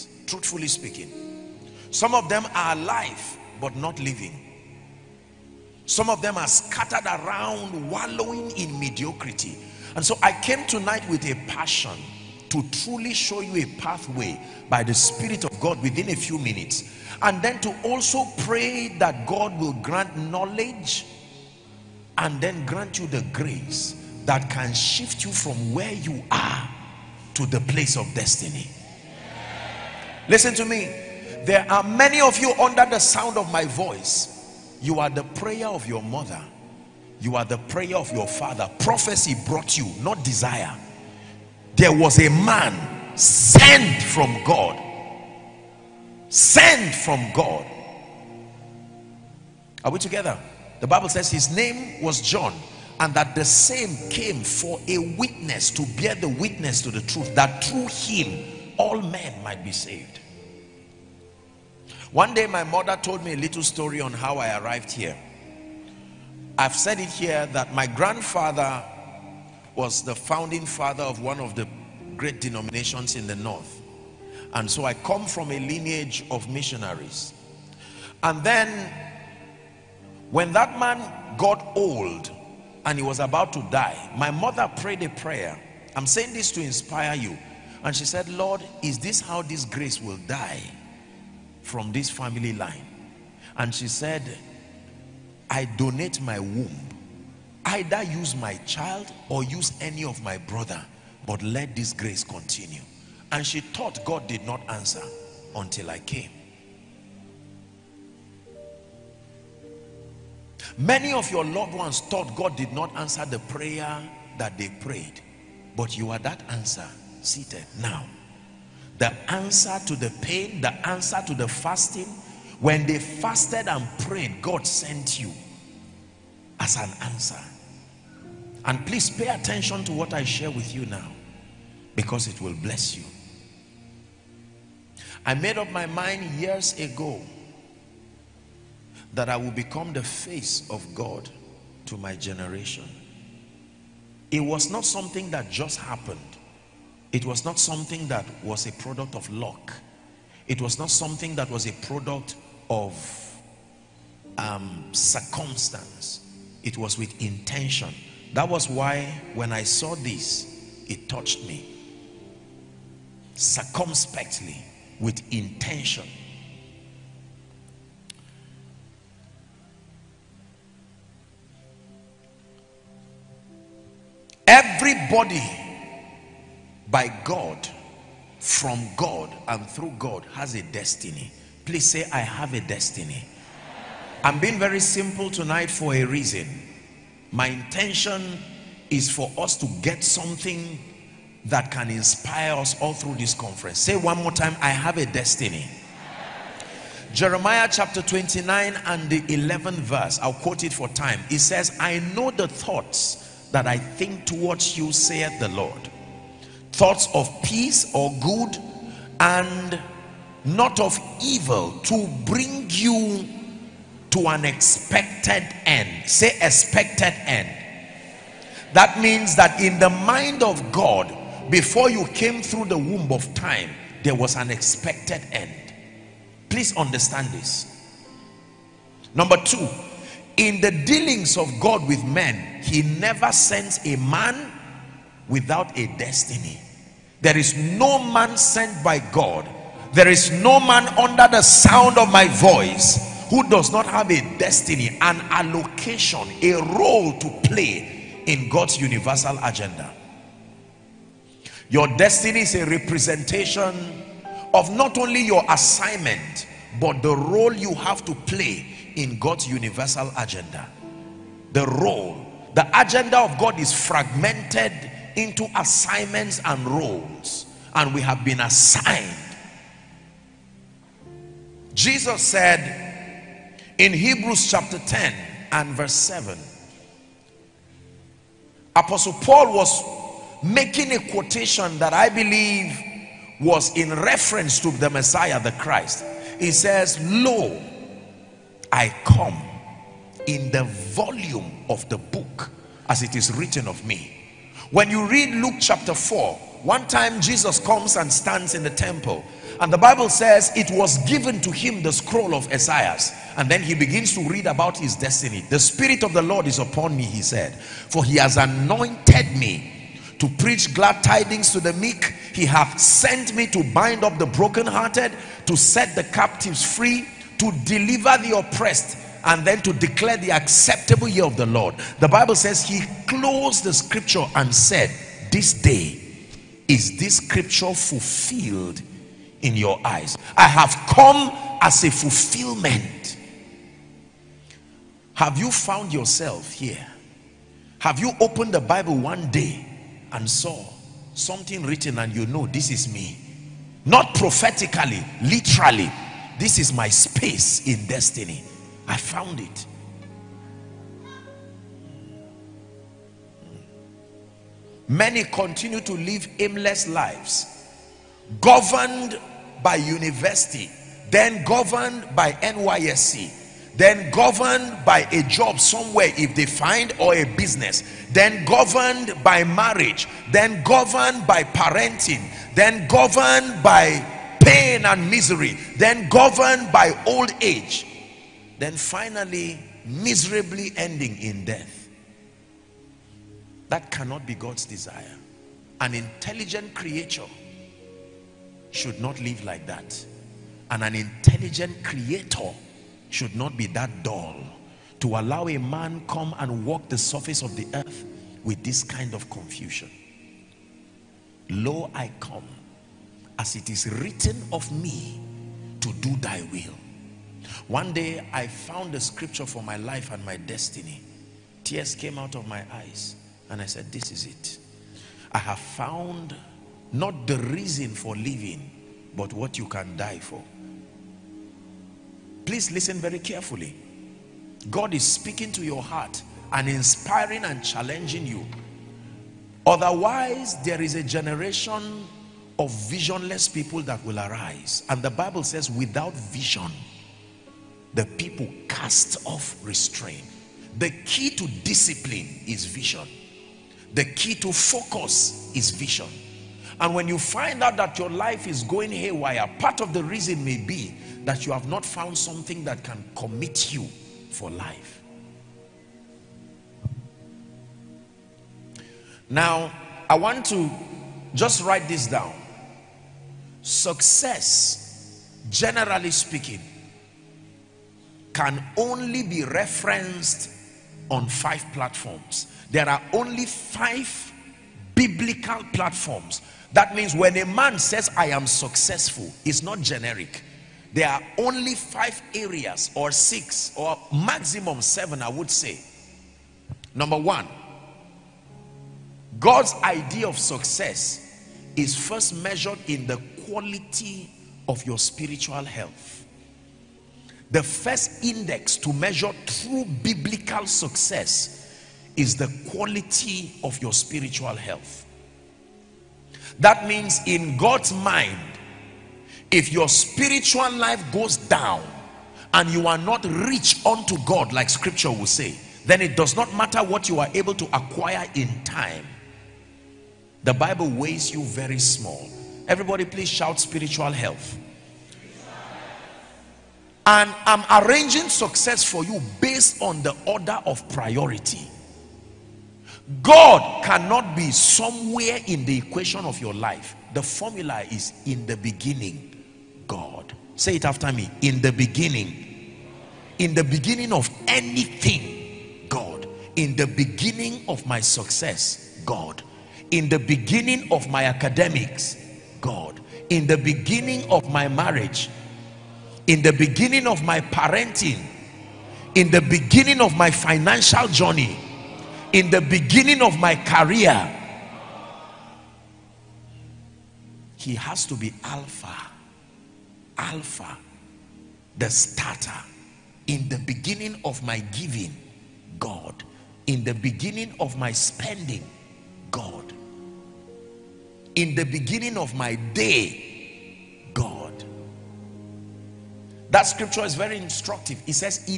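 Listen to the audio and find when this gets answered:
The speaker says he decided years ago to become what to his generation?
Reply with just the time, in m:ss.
2:19.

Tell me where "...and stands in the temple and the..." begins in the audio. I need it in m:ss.
4:57.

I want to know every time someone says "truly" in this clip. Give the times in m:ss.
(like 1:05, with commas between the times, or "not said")
0:12.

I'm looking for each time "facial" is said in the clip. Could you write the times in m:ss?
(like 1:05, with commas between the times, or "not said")
not said.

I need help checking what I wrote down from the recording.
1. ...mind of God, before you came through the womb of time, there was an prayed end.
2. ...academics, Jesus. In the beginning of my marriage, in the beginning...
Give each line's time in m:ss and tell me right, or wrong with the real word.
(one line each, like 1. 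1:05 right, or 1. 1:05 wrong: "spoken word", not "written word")
1. 3:39 wrong: "expected", not "prayed"
2. 9:11 wrong: "God", not "Jesus".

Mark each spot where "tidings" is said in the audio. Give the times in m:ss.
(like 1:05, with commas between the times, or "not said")
5:11.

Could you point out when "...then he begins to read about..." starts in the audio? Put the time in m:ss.
5:03.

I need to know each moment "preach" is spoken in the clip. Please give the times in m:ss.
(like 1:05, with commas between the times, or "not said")
5:10.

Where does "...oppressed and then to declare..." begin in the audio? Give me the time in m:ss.
5:18.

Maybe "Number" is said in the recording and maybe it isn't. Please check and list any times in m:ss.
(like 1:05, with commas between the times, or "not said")
3:49, 8:06.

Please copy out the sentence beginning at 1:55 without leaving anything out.
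But you are that answer seated now.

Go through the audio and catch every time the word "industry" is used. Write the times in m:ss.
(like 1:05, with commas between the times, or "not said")
not said.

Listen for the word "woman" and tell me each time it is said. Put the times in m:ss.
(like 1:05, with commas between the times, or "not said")
not said.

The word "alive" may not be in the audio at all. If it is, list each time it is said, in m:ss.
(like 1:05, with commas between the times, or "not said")
0:02.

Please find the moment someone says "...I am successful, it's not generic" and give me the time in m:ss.
7:58.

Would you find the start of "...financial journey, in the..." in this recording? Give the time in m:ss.
9:20.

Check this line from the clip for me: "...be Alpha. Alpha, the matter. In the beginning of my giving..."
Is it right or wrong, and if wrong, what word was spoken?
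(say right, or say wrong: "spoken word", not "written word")
wrong: "starter", not "matter".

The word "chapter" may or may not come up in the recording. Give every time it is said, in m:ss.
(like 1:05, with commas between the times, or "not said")
3:17, 4:34, 4:55.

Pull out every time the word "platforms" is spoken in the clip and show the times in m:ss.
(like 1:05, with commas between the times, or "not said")
7:51, 7:55.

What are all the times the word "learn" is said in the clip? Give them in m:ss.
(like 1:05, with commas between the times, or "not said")
not said.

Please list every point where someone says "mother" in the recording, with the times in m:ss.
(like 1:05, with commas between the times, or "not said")
0:36, 1:02, 1:24.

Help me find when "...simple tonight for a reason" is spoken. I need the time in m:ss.
3:04.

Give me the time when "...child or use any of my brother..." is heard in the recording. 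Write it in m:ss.
1:38.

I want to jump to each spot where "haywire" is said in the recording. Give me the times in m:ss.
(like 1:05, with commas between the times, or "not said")
7:28.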